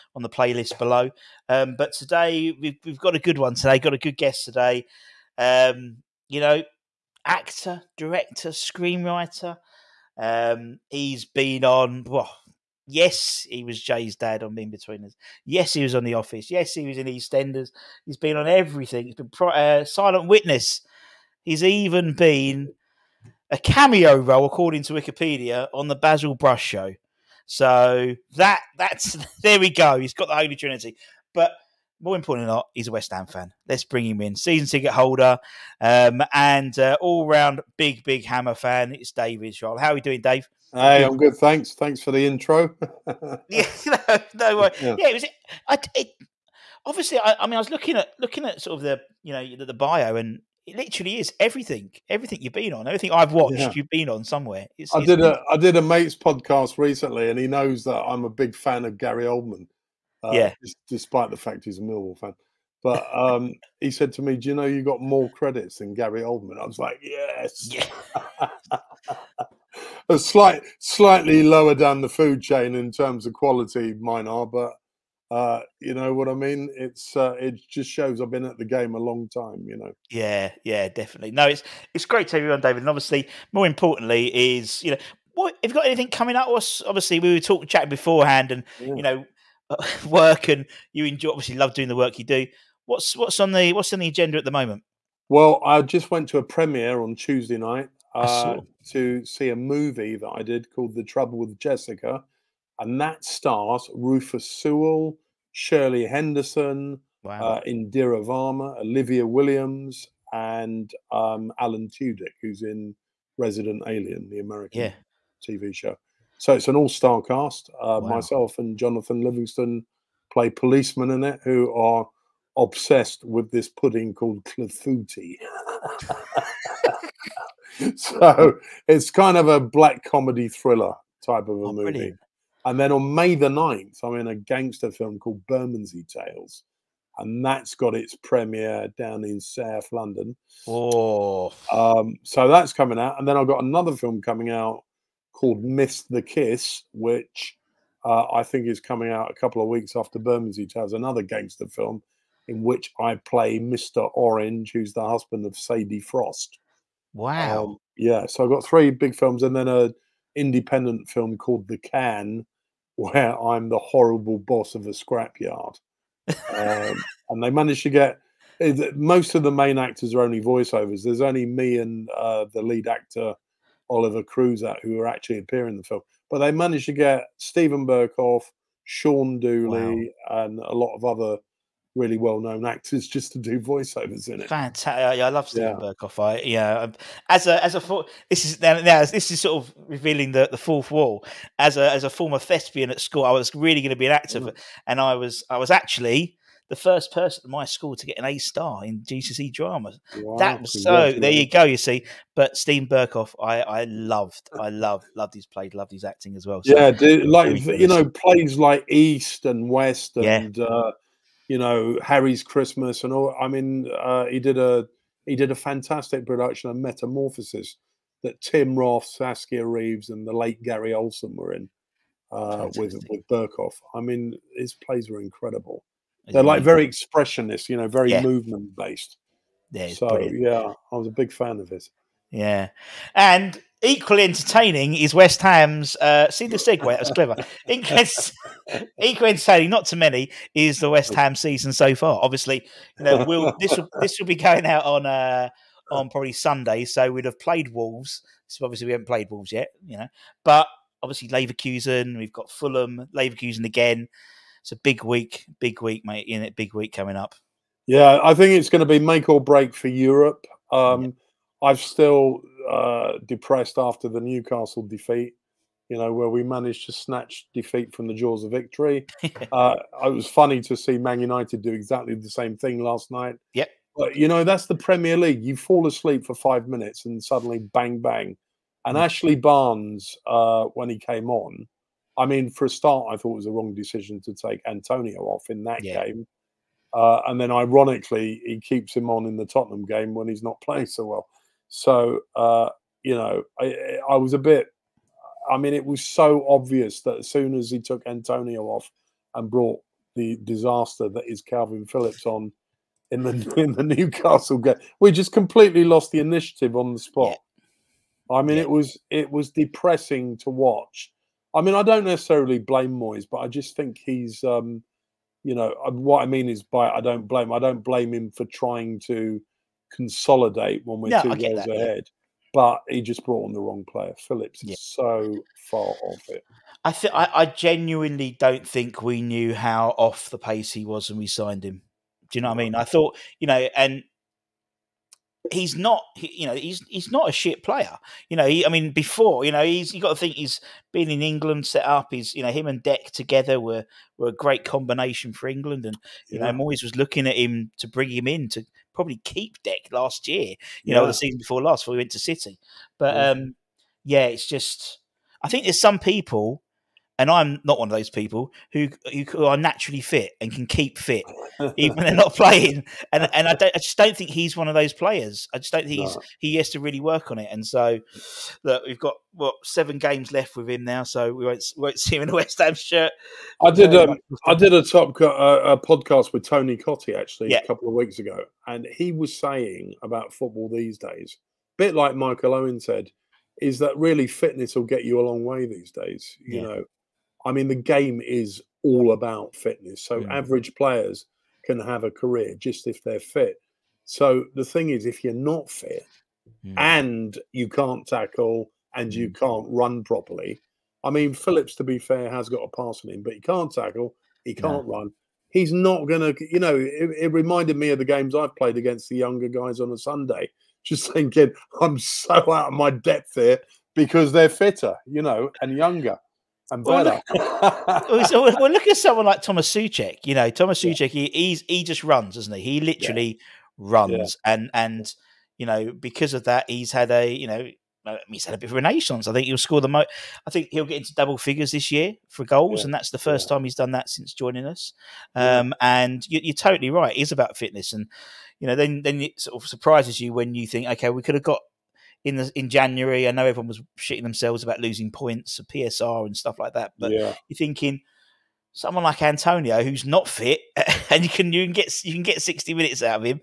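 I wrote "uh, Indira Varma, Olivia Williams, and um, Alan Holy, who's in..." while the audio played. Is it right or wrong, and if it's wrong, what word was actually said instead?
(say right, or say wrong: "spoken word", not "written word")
wrong: "Tudyk", not "Holy".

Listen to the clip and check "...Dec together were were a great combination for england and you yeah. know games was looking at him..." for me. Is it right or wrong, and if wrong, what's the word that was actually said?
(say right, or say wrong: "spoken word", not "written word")
wrong: "moyes", not "games".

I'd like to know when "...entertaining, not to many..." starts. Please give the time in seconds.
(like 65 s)
239 s.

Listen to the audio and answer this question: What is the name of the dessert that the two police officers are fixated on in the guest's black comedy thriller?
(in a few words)
clafouti.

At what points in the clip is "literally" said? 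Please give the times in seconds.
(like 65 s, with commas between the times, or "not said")
50 s, 422 s.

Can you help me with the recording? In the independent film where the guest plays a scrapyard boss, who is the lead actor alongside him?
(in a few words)
Oliver Cruz.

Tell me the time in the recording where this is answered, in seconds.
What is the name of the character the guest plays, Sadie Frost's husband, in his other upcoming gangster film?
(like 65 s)
153 s.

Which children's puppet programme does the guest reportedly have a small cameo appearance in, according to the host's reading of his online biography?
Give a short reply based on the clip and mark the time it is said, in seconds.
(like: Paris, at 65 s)
Basil Brush Show, at 25 s.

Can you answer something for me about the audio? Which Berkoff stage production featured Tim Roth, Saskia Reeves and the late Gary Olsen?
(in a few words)
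Metamorphosis.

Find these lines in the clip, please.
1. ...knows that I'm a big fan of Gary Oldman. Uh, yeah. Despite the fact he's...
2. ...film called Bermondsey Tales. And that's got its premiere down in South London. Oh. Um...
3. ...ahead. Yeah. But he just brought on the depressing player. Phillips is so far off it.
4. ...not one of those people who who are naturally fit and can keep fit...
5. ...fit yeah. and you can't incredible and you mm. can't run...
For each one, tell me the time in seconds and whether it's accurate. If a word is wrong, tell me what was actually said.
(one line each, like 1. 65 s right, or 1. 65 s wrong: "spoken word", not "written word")
1. 57 s right
2. 134 s right
3. 321 s wrong: "wrong", not "depressing"
4. 357 s right
5. 395 s wrong: "tackle", not "incredible".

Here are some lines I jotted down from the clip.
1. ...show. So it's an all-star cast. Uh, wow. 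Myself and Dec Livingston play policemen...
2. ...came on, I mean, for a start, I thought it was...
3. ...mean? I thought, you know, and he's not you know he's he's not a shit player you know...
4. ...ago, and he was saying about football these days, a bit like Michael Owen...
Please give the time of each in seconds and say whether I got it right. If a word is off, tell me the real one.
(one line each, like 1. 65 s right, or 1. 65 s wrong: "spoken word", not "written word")
1. 115 s wrong: "Jonathan", not "Dec"
2. 280 s right
3. 332 s right
4. 378 s right.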